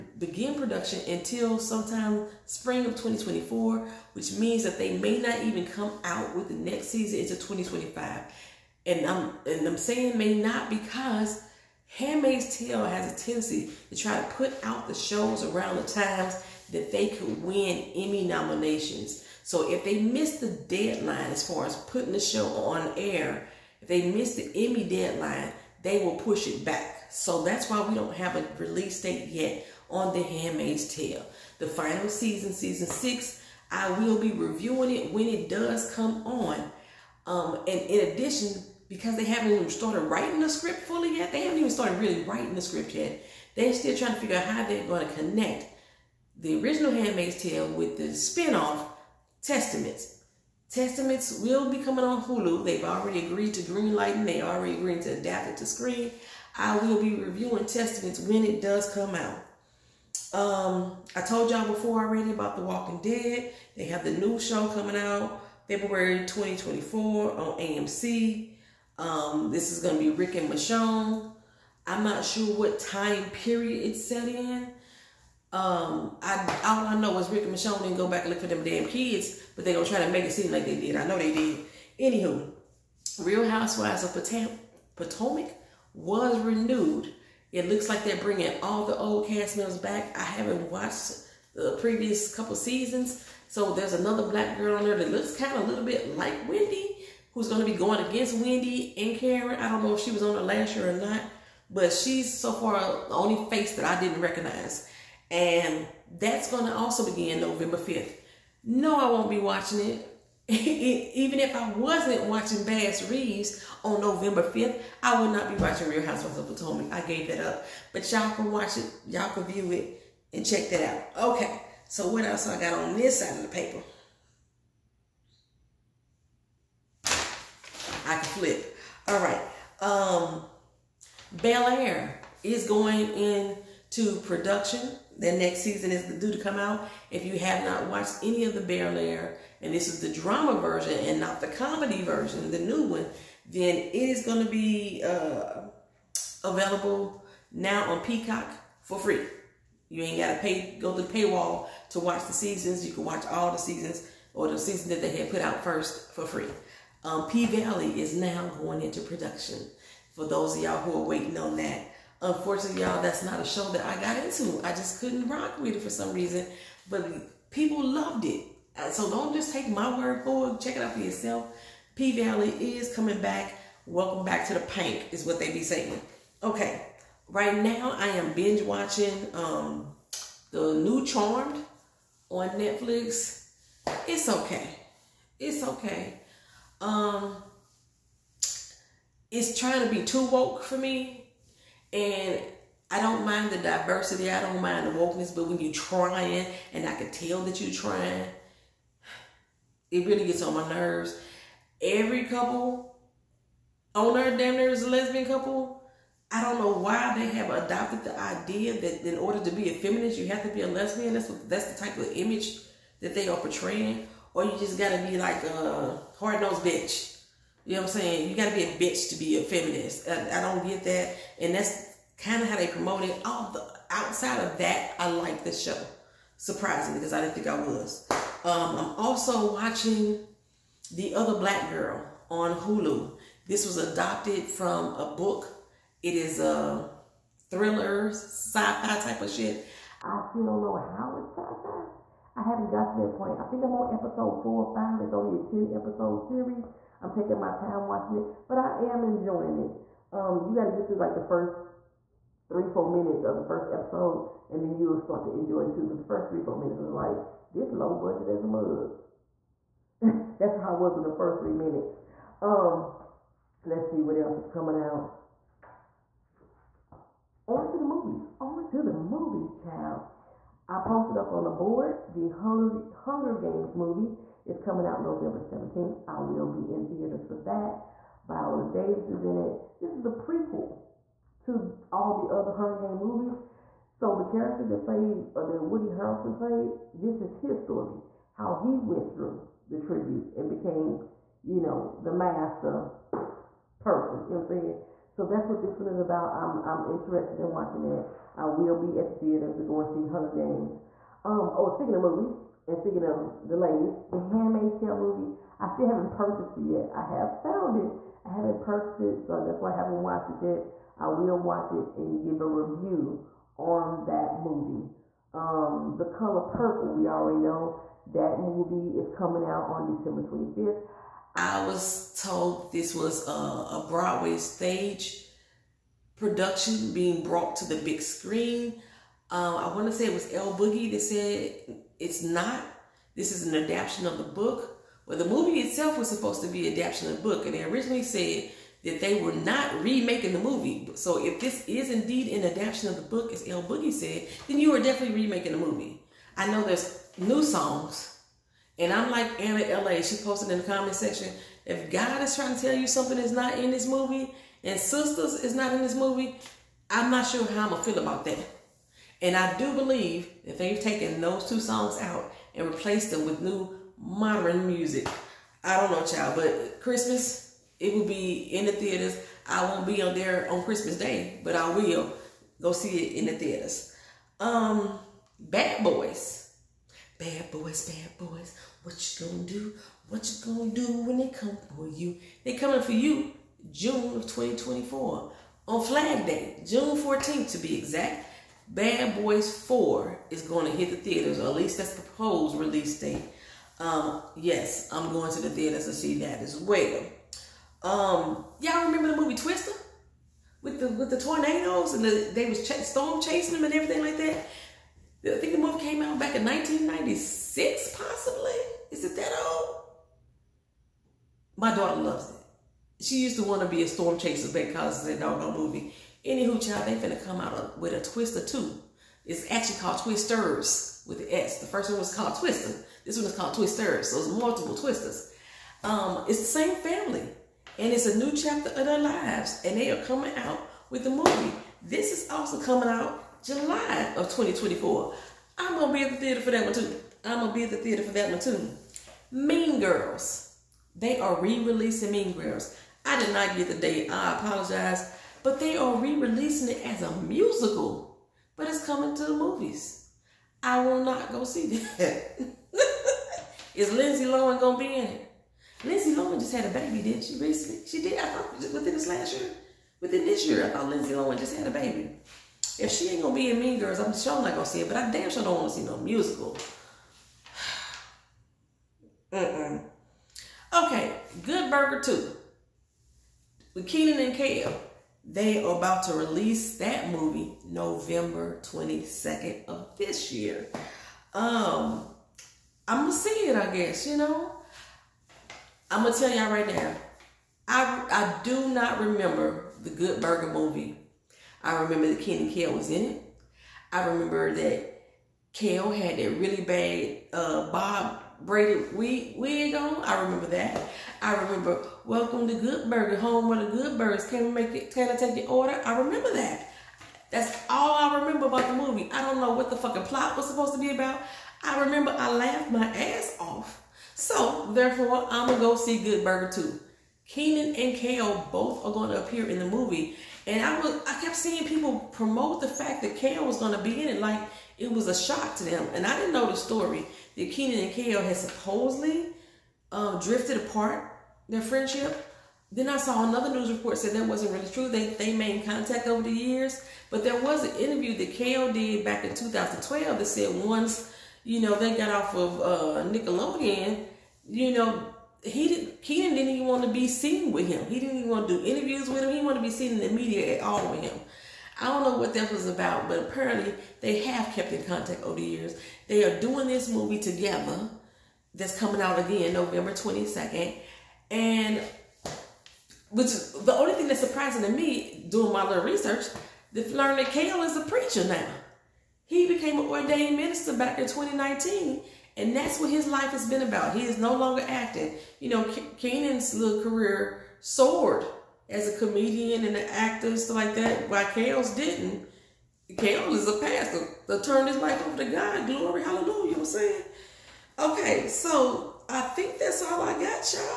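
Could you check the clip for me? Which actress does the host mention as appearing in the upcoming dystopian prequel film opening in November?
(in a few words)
Viola Davis.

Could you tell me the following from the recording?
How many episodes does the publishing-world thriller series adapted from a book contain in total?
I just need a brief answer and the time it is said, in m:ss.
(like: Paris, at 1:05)
10, at 4:05.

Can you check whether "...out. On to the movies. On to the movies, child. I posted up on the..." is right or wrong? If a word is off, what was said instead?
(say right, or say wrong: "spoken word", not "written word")
right.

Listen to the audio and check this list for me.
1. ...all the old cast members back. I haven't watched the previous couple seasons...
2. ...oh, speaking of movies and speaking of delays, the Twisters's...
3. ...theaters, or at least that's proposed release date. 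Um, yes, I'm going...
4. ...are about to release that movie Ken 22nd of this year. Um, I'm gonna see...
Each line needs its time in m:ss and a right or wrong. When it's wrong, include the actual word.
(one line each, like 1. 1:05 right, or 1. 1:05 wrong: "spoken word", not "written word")
1. 1:28 right
2. 5:01 wrong: "Handmaid", not "Twisters"
3. 6:30 right
4. 7:55 wrong: "November", not "Ken".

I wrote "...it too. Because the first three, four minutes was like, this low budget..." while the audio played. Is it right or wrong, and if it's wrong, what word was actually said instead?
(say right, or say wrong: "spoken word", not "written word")
right.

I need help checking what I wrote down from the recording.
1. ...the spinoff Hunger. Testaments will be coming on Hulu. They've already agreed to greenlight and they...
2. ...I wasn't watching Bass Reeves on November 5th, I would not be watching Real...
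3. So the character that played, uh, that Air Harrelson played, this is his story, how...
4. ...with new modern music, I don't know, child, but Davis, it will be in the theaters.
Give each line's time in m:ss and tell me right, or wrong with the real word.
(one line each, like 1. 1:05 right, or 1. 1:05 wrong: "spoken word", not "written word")
1. 0:47 wrong: "Testaments", not "Hunger"
2. 1:51 right
3. 4:43 wrong: "Woody", not "Air"
4. 6:03 wrong: "Christmas", not "Davis".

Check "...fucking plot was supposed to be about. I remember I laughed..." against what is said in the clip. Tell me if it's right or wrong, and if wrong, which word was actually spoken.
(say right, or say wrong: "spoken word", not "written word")
right.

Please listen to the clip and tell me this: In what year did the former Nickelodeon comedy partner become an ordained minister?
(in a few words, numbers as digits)
2019.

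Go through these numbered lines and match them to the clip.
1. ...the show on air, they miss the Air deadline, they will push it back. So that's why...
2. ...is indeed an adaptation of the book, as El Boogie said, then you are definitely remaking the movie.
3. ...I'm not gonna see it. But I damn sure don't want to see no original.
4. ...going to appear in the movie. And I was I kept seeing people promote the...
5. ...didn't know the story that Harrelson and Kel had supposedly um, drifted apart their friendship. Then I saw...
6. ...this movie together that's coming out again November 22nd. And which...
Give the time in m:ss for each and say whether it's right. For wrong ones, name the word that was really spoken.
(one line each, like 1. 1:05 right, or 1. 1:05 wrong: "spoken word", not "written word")
1. 0:22 wrong: "Emmy", not "Air"
2. 5:41 right
3. 7:44 wrong: "musical", not "original"
4. 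8:38 right
5. 8:46 wrong: "Kenan", not "Harrelson"
6. 9:16 right.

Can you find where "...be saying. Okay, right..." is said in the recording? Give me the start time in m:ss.
2:55.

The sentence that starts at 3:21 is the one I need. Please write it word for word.
Every couple on earth damn near is a lesbian couple.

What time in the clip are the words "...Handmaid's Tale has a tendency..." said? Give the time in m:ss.
0:11.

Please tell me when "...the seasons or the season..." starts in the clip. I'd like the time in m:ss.
2:33.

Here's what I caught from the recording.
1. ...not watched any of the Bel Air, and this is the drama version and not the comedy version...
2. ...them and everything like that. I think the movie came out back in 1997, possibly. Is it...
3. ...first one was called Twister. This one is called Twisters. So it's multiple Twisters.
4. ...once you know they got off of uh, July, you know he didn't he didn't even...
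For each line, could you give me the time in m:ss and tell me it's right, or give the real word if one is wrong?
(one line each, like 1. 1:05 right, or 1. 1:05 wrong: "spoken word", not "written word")
1. 2:17 right
2. 6:43 wrong: "1996", not "1997"
3. 7:01 right
4. 9:00 wrong: "Nickelodeon", not "July".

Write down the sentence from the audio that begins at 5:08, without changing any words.
I haven't purchased it, so that's why I haven't watched it yet.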